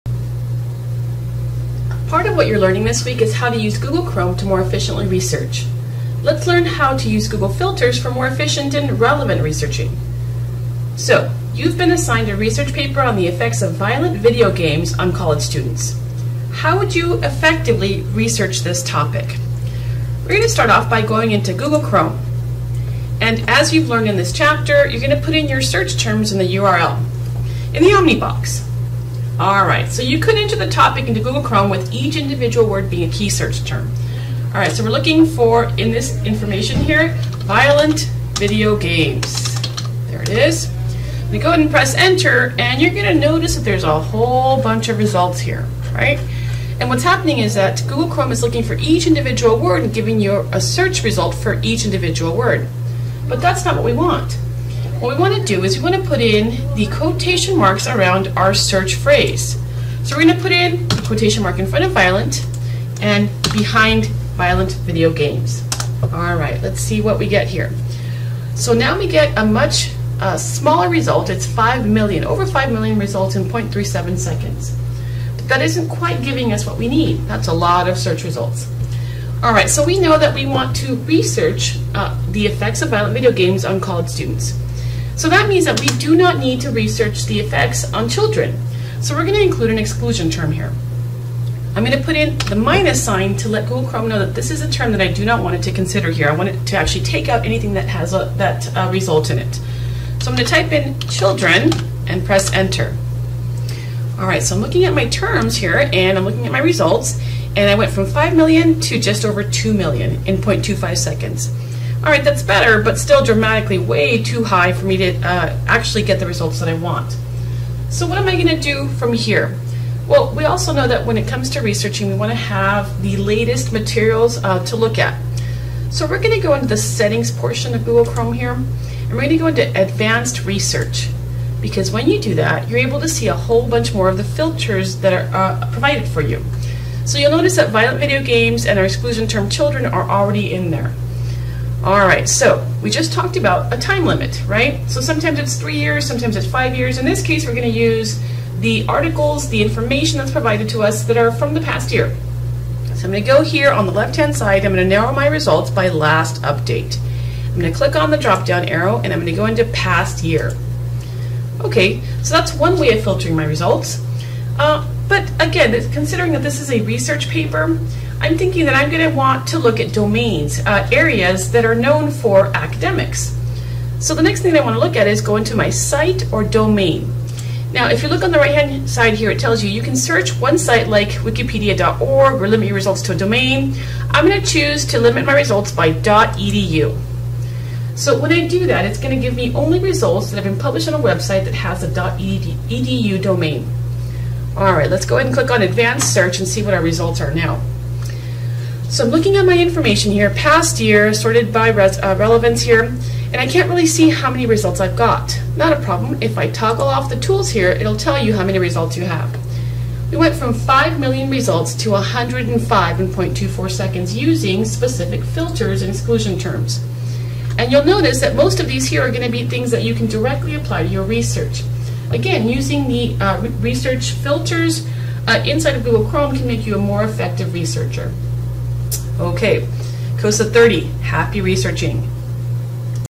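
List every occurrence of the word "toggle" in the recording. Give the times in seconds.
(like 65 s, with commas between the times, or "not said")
206 s.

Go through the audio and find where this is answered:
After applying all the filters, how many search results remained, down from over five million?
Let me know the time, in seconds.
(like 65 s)
211 s.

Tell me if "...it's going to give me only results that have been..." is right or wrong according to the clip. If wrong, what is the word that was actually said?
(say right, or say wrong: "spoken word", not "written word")
right.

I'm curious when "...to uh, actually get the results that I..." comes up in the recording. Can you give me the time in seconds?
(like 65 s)
114 s.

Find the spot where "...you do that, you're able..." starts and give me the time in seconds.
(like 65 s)
132 s.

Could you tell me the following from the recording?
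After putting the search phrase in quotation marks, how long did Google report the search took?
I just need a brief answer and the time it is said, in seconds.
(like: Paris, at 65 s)
0.37 seconds, at 73 s.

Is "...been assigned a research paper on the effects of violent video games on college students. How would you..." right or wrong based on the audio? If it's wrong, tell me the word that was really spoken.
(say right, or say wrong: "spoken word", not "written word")
right.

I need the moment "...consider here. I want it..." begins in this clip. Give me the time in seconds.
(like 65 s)
95 s.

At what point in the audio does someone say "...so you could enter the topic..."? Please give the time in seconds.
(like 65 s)
29 s.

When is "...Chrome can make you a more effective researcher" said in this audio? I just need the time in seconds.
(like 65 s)
226 s.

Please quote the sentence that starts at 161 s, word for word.
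Okay, so that's one way of filtering my results.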